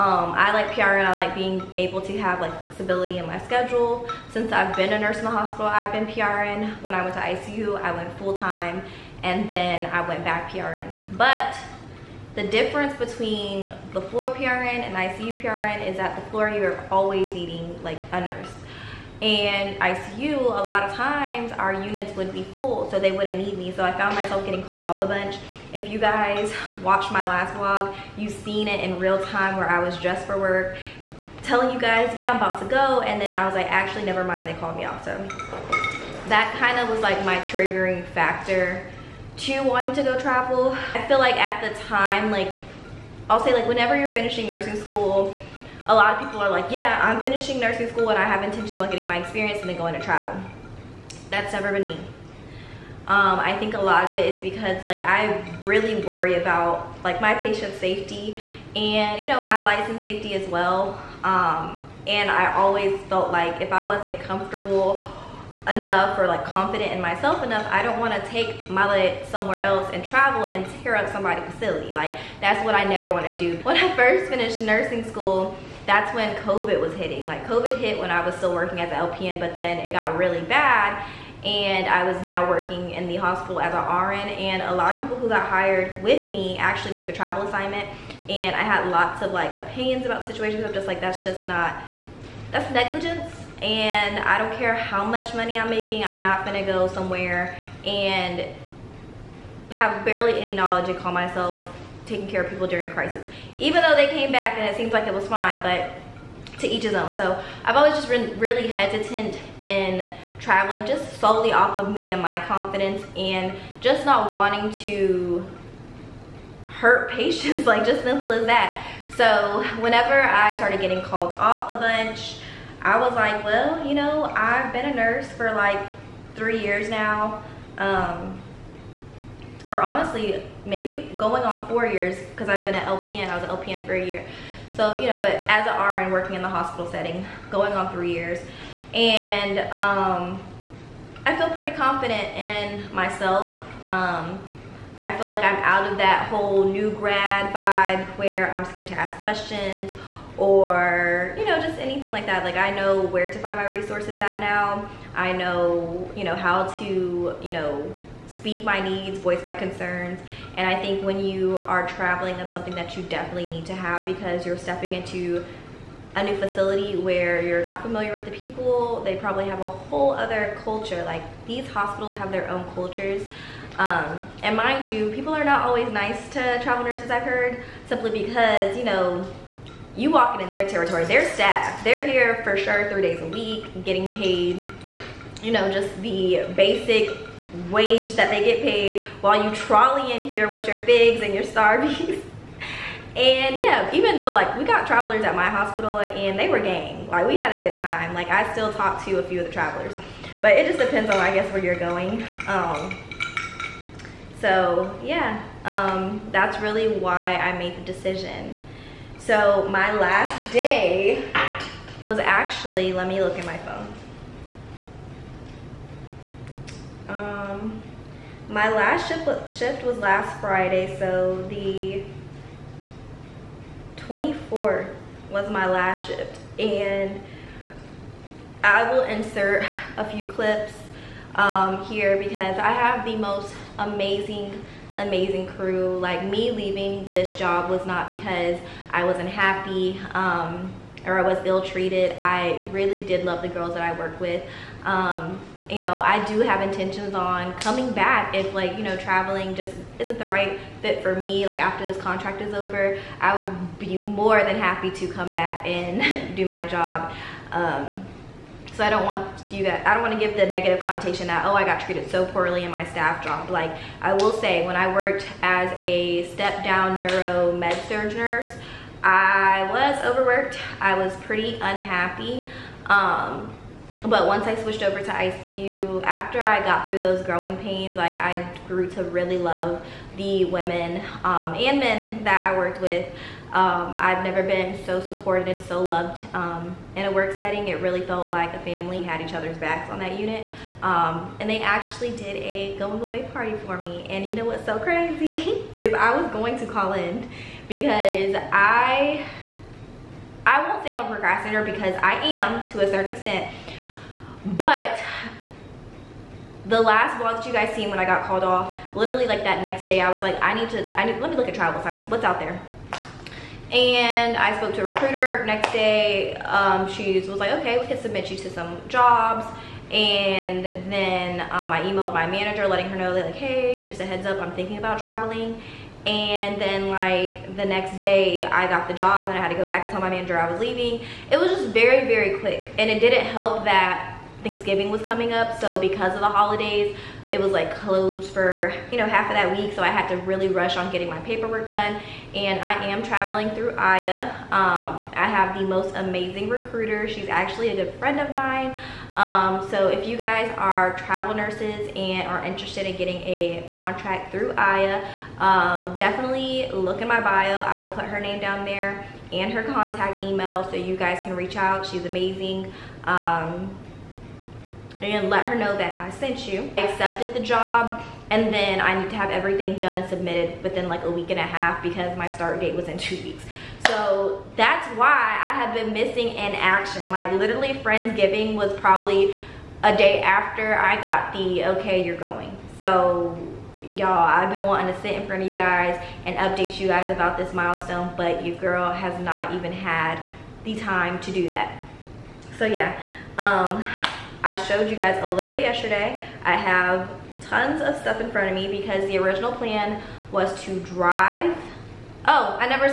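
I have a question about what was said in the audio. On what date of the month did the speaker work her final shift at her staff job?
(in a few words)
24th.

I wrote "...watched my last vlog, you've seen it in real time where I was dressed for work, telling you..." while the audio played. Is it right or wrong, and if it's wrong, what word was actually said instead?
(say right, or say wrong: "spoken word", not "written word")
right.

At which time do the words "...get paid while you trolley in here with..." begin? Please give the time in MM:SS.
03:08.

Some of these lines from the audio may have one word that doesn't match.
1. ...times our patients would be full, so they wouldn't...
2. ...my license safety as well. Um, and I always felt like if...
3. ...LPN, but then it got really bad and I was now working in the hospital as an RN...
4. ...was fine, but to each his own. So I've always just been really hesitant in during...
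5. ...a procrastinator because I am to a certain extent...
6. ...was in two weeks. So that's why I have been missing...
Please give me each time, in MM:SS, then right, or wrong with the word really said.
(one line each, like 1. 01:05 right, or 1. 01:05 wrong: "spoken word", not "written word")
1. 00:20 wrong: "units", not "patients"
2. 00:59 right
3. 01:18 right
4. 01:45 wrong: "traveling", not "during"
5. 05:01 right
6. 06:12 right.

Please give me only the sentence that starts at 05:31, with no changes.
It was just very, very quick.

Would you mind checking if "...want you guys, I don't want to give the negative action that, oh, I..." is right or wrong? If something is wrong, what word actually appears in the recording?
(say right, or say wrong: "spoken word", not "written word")
wrong: "connotation", not "action".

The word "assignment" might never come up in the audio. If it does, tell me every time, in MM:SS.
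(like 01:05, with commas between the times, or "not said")
01:27, 05:11.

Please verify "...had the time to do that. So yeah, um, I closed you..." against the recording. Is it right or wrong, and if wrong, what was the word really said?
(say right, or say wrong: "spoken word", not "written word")
wrong: "showed", not "closed".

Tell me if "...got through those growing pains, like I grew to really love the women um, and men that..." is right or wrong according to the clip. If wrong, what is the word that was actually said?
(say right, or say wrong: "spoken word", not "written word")
right.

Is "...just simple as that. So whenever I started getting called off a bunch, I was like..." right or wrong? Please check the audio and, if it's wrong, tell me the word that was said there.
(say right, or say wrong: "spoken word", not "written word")
right.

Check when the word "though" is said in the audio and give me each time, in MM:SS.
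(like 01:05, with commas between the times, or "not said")
01:43, 03:14.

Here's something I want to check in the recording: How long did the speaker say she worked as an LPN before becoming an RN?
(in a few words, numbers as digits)
a year.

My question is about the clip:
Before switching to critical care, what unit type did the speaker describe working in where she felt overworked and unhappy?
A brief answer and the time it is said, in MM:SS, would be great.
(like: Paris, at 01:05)
step down neuro med surg, at 04:26.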